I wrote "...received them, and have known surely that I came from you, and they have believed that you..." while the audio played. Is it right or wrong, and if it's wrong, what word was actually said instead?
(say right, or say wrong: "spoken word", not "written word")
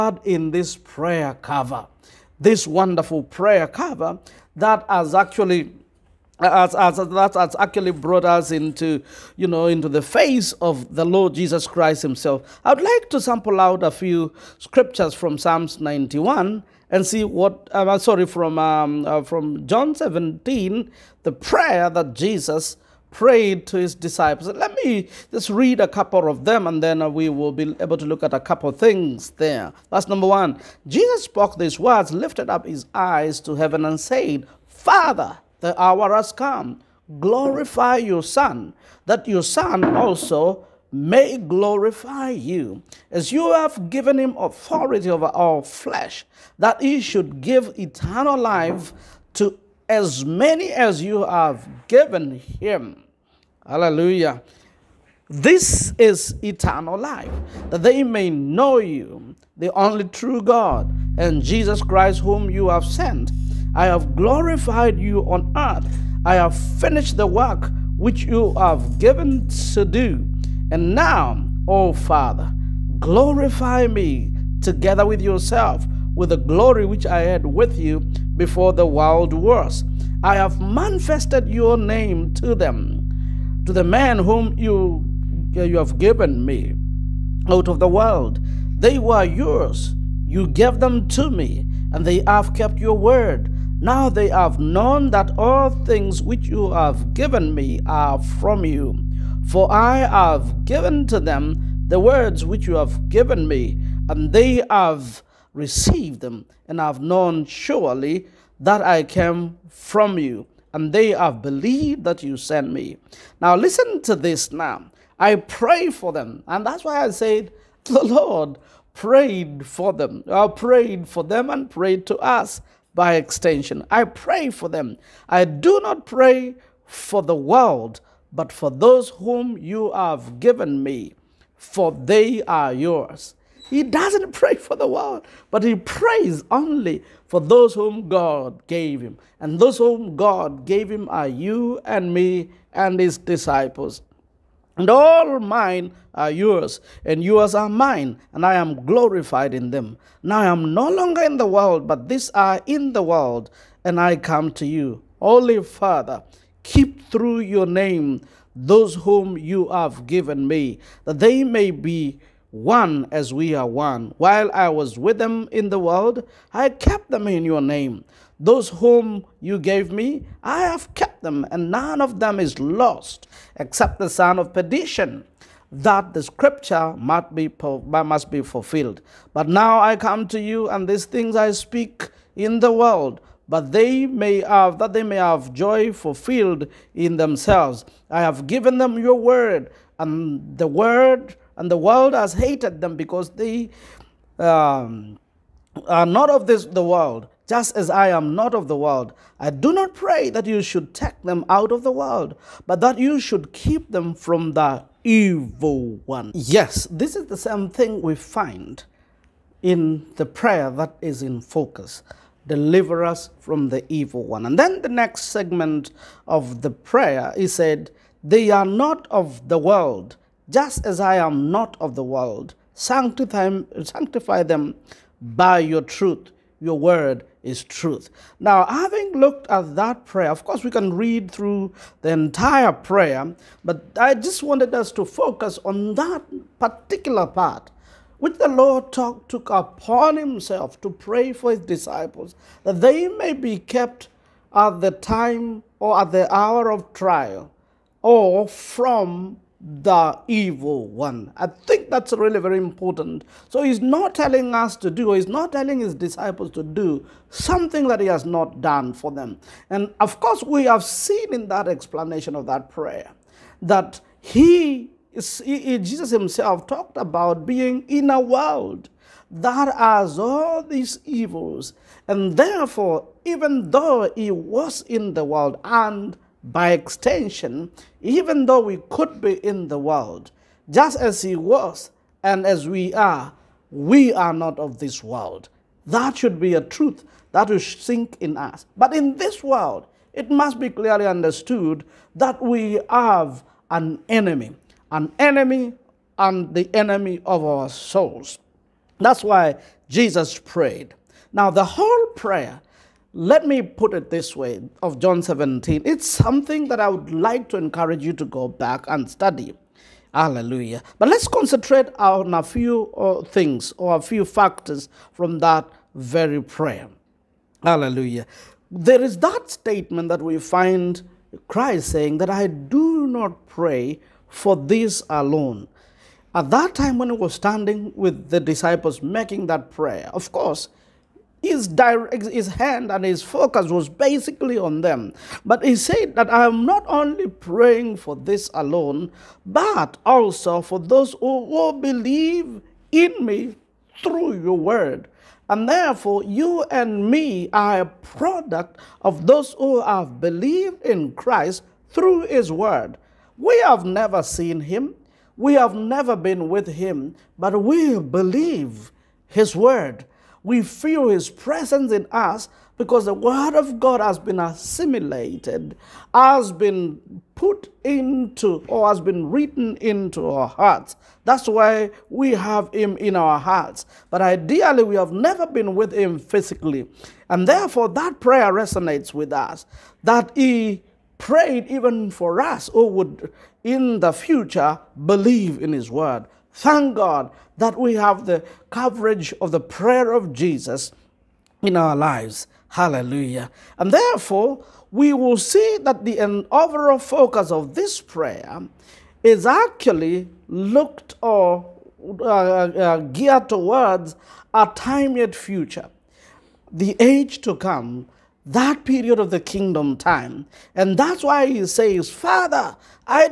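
right.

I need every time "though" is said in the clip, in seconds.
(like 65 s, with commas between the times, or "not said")
273 s, 278 s.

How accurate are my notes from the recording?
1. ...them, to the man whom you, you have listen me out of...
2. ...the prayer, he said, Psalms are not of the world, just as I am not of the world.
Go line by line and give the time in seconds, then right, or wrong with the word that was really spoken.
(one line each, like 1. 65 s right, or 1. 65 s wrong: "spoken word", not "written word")
1. 82 s wrong: "given", not "listen"
2. 216 s wrong: "They", not "Psalms".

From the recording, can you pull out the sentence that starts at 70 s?
And now, O oh Father, glorify me together with yourself with the glory which I had with you before the world was.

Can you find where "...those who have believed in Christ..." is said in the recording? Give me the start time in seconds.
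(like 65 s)
349 s.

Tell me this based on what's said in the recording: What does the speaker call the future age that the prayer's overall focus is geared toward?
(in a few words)
The kingdom time.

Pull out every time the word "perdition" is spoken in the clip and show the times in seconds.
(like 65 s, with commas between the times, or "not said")
174 s.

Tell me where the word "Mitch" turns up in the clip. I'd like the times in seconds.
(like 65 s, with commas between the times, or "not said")
not said.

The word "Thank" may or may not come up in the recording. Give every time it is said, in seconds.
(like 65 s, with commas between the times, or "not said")
386 s.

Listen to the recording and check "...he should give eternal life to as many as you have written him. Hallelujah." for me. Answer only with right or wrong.
wrong.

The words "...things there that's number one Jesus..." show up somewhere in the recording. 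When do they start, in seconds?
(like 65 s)
28 s.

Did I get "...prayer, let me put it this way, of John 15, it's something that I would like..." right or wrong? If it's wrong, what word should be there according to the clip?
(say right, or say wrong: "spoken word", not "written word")
wrong: "17", not "15".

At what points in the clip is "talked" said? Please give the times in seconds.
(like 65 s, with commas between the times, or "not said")
266 s.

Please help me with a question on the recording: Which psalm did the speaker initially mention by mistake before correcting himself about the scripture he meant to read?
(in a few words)
Psalm 91.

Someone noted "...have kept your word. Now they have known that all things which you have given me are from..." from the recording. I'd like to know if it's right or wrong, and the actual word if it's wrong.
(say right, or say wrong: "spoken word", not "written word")
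right.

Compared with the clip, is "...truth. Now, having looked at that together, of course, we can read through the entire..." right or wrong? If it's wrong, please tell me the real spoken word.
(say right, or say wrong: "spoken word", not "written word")
wrong: "prayer", not "together".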